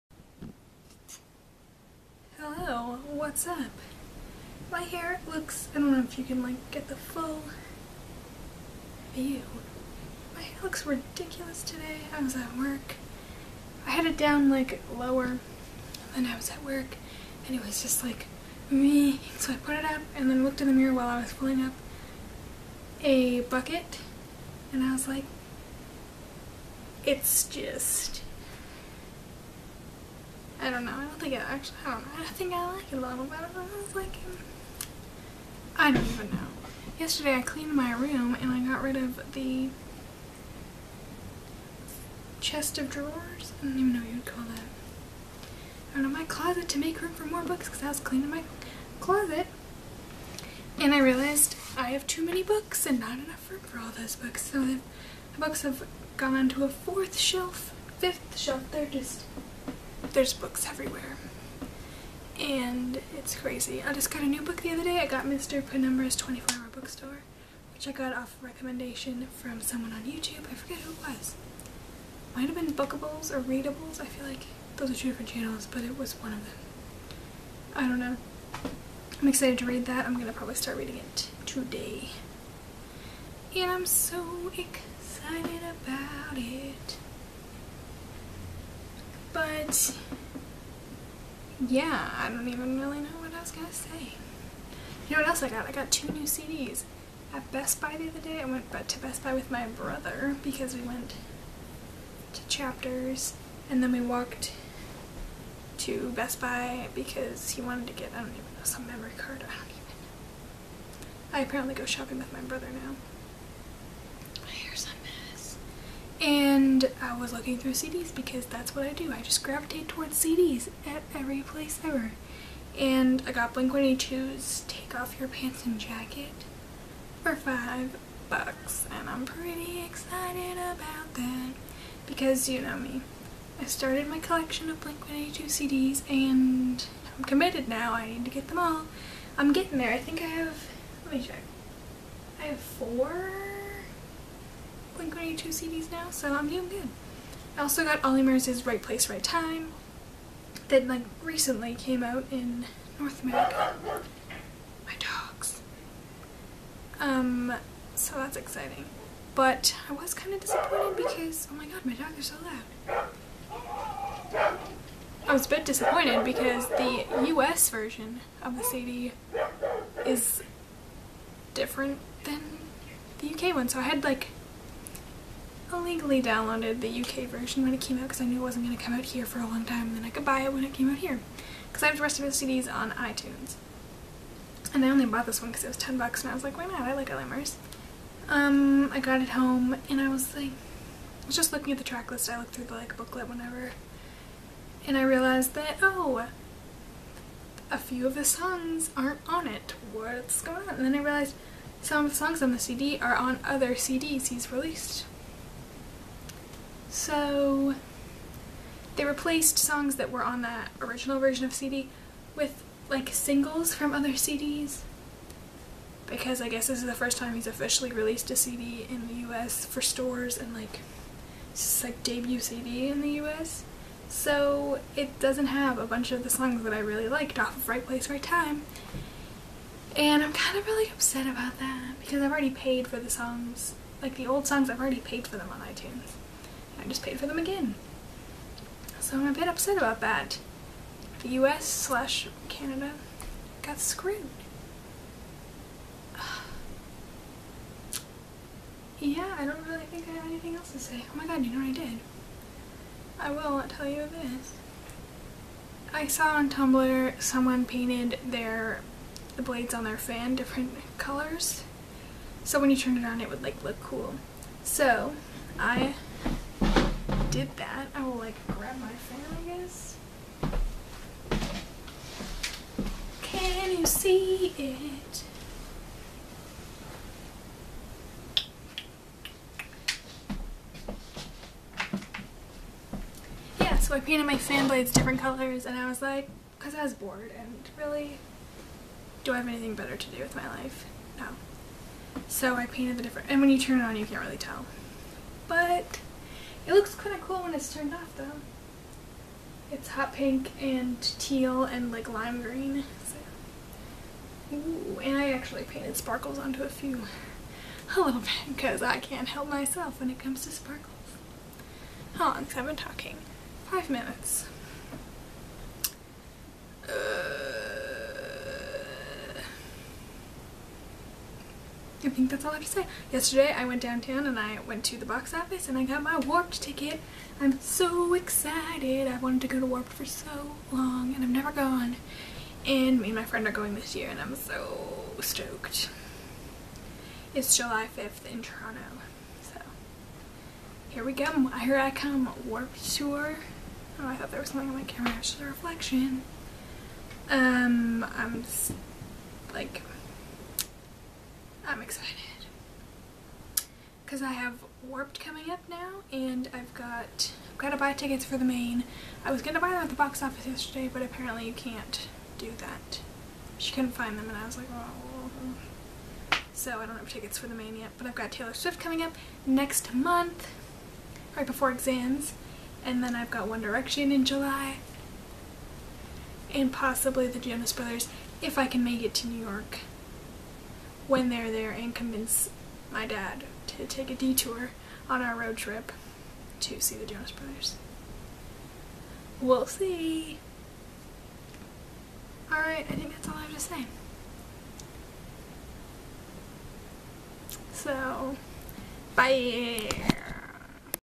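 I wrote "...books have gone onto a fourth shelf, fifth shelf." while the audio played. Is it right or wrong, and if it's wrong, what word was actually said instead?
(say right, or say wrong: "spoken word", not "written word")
right.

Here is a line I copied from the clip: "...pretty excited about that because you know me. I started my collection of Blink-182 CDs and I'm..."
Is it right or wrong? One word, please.
right.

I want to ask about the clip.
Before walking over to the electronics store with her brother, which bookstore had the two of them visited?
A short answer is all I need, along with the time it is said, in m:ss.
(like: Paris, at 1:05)
Chapters, at 1:42.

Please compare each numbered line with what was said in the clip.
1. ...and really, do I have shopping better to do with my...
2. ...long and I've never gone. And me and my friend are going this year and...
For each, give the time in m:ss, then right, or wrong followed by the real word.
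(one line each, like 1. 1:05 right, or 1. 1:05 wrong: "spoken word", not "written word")
1. 4:47 wrong: "anything", not "shopping"
2. 5:30 right.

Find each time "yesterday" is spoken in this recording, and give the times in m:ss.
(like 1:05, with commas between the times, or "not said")
0:36, 5:23, 6:00.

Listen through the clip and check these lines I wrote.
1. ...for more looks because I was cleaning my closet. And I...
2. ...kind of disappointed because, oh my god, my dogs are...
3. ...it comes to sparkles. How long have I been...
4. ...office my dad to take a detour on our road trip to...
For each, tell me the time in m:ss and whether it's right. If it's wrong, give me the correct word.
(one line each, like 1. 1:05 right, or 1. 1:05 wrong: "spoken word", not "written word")
1. 0:47 wrong: "books", not "looks"
2. 2:40 right
3. 5:10 right
4. 6:21 wrong: "convince", not "office".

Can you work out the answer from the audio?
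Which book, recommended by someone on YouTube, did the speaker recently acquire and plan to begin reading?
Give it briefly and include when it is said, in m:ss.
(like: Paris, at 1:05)
Mr. Penumbra's 24-hour bookstore, at 1:05.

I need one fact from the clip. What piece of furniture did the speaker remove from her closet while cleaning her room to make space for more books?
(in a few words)
chest of drawers.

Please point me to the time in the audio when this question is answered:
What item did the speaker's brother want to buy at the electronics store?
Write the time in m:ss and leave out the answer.
1:48.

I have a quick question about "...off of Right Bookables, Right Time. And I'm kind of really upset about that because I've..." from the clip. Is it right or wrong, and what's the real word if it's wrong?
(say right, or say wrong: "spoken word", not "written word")
wrong: "Place", not "Bookables".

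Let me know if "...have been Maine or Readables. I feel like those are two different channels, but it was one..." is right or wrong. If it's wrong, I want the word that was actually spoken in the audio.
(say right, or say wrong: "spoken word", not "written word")
wrong: "Bookables", not "Maine".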